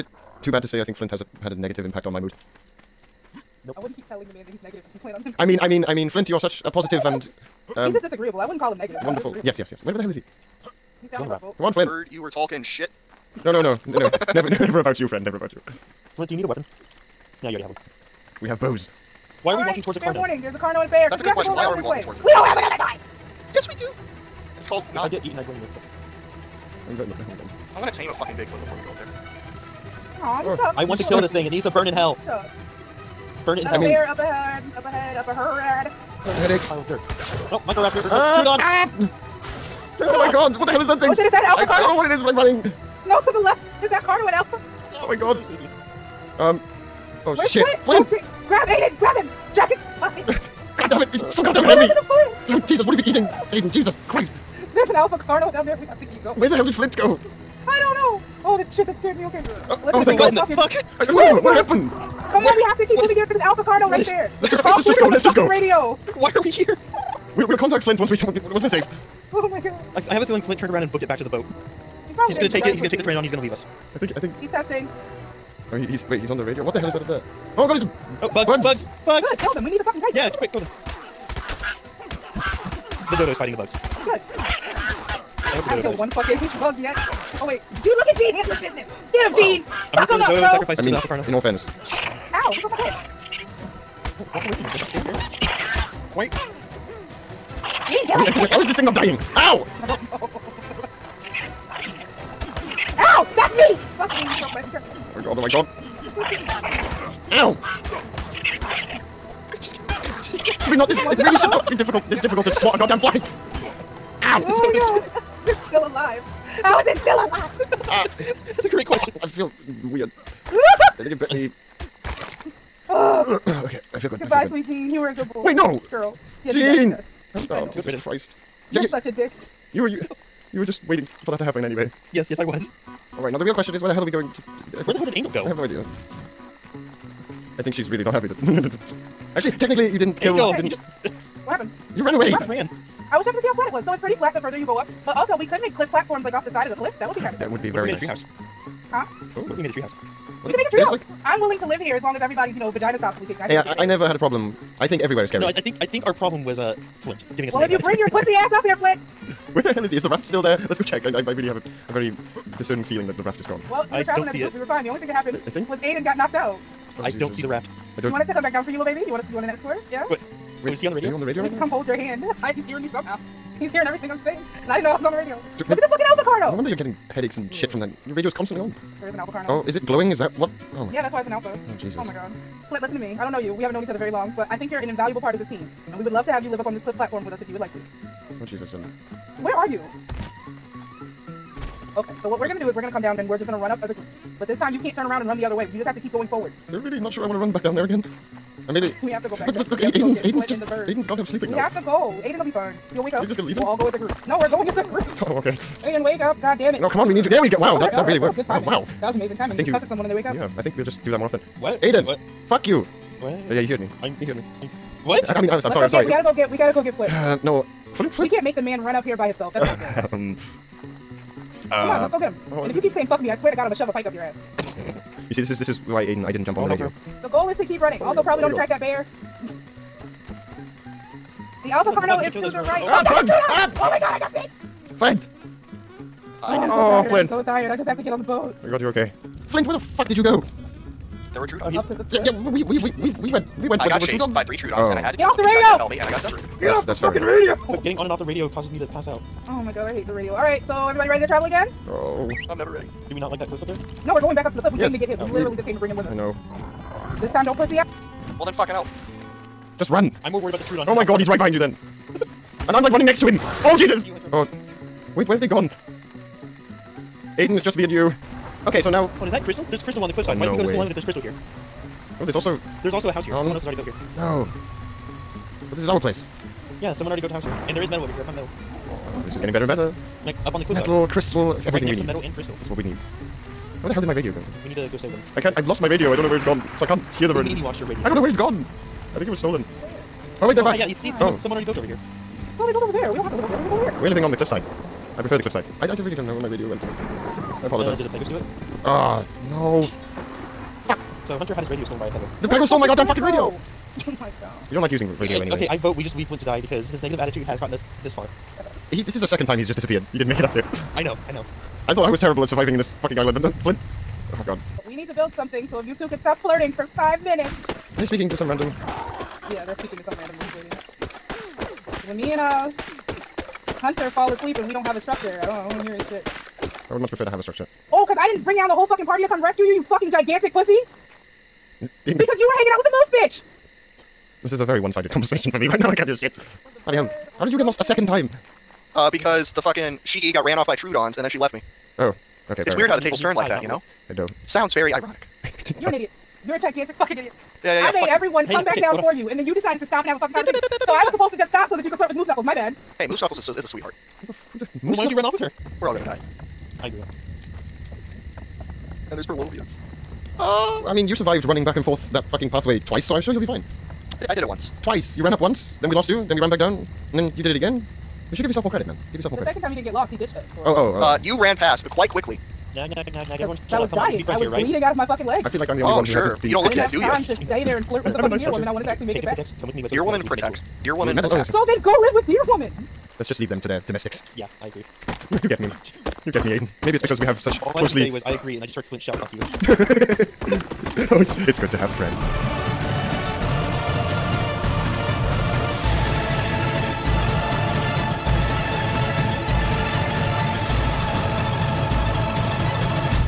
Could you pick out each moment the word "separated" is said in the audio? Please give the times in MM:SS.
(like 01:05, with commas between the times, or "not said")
04:06.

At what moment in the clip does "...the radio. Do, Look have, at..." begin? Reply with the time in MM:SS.
02:55.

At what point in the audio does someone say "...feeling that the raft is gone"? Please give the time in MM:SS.
02:42.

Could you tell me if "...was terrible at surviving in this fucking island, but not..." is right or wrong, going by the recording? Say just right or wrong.
right.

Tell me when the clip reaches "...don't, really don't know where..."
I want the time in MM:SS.
04:55.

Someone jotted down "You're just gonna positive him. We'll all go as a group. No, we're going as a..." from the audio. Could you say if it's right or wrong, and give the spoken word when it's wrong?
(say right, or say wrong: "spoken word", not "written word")
wrong: "leave", not "positive".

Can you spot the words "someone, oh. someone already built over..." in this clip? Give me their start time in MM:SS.
04:51.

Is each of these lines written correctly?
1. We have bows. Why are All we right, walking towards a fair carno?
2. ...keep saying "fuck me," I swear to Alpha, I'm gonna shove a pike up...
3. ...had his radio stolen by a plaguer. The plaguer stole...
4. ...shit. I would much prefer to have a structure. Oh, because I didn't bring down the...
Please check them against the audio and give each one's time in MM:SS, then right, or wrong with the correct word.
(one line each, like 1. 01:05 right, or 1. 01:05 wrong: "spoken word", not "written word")
1. 00:18 right
2. 03:42 wrong: "God", not "Alpha"
3. 05:01 right
4. 05:26 right.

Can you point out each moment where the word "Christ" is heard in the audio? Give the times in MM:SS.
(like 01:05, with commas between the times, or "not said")
00:54, 02:07.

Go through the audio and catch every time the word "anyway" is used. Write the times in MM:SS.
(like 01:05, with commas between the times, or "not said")
02:11, 05:05.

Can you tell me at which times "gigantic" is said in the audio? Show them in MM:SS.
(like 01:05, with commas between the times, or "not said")
05:30, 05:46.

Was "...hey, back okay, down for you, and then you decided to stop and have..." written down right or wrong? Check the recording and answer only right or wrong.
right.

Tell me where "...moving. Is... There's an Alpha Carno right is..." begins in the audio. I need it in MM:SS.
01:03.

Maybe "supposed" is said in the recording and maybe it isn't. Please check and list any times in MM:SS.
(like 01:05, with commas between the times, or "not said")
05:51.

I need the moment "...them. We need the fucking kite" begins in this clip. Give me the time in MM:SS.
01:19.